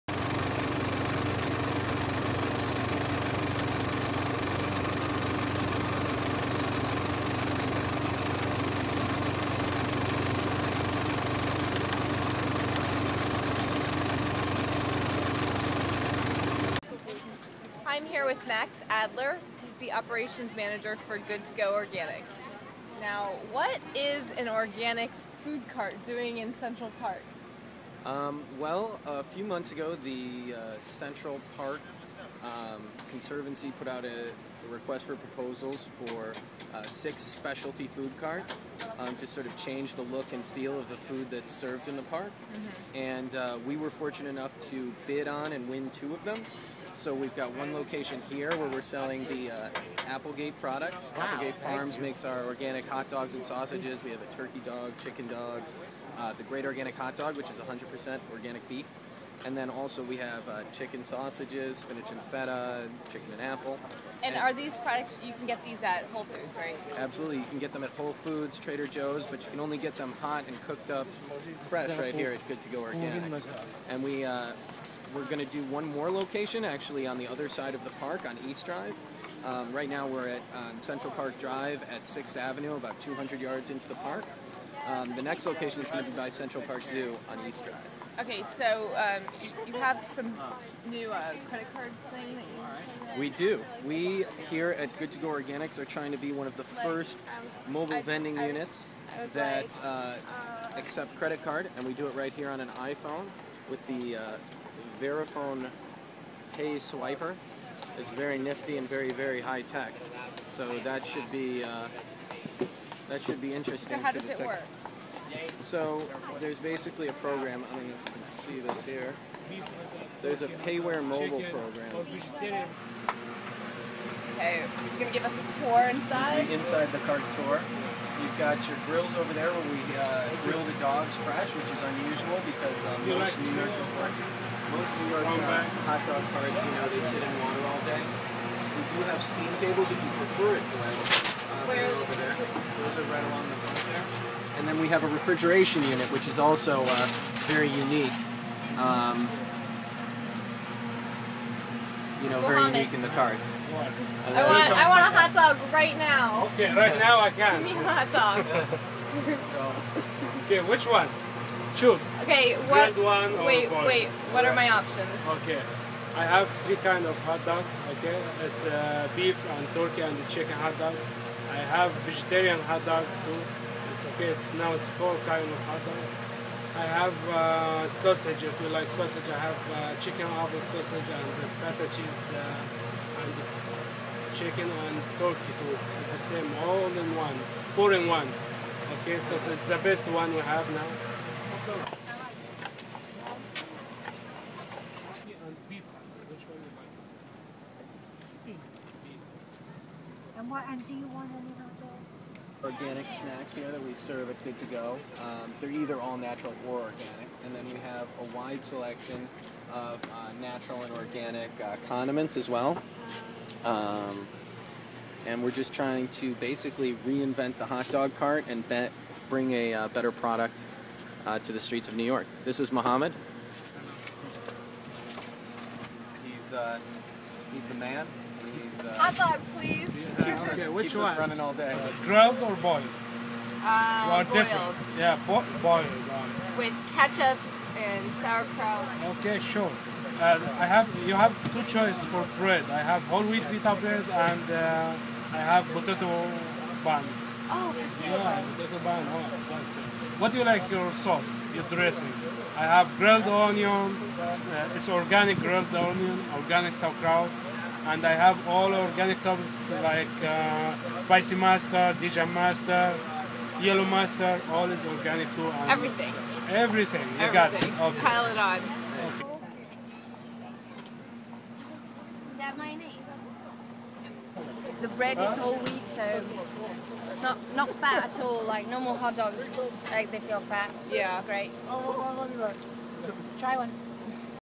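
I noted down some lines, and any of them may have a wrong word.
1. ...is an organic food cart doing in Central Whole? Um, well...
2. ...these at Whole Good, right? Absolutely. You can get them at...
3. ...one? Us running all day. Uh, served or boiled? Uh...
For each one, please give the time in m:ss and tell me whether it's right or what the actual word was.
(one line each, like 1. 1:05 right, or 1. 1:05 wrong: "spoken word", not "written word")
1. 0:23 wrong: "Park", not "Whole"
2. 1:05 wrong: "Foods", not "Good"
3. 3:50 wrong: "grilled", not "served".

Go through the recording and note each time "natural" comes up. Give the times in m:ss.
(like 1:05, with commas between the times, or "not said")
3:26, 3:30.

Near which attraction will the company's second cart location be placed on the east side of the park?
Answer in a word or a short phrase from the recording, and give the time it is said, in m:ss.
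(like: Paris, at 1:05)
Central Park Zoo, at 1:26.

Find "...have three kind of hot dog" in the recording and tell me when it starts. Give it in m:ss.
2:46.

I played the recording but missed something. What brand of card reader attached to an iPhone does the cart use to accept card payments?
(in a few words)
Verifone.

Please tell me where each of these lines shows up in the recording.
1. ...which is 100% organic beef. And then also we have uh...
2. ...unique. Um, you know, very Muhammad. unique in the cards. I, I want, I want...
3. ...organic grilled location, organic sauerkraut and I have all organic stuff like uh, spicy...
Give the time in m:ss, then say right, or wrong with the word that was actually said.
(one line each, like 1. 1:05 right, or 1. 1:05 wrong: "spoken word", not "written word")
1. 0:57 right
2. 2:27 right
3. 4:14 wrong: "onion", not "location".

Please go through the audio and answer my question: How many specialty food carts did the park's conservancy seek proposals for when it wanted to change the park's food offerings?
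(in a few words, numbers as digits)
6.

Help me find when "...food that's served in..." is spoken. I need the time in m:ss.
0:40.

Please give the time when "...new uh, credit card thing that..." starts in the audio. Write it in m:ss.
1:30.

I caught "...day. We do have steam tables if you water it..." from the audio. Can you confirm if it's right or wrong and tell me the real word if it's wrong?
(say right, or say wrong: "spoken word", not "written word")
wrong: "prefer", not "water".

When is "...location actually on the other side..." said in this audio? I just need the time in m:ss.
1:16.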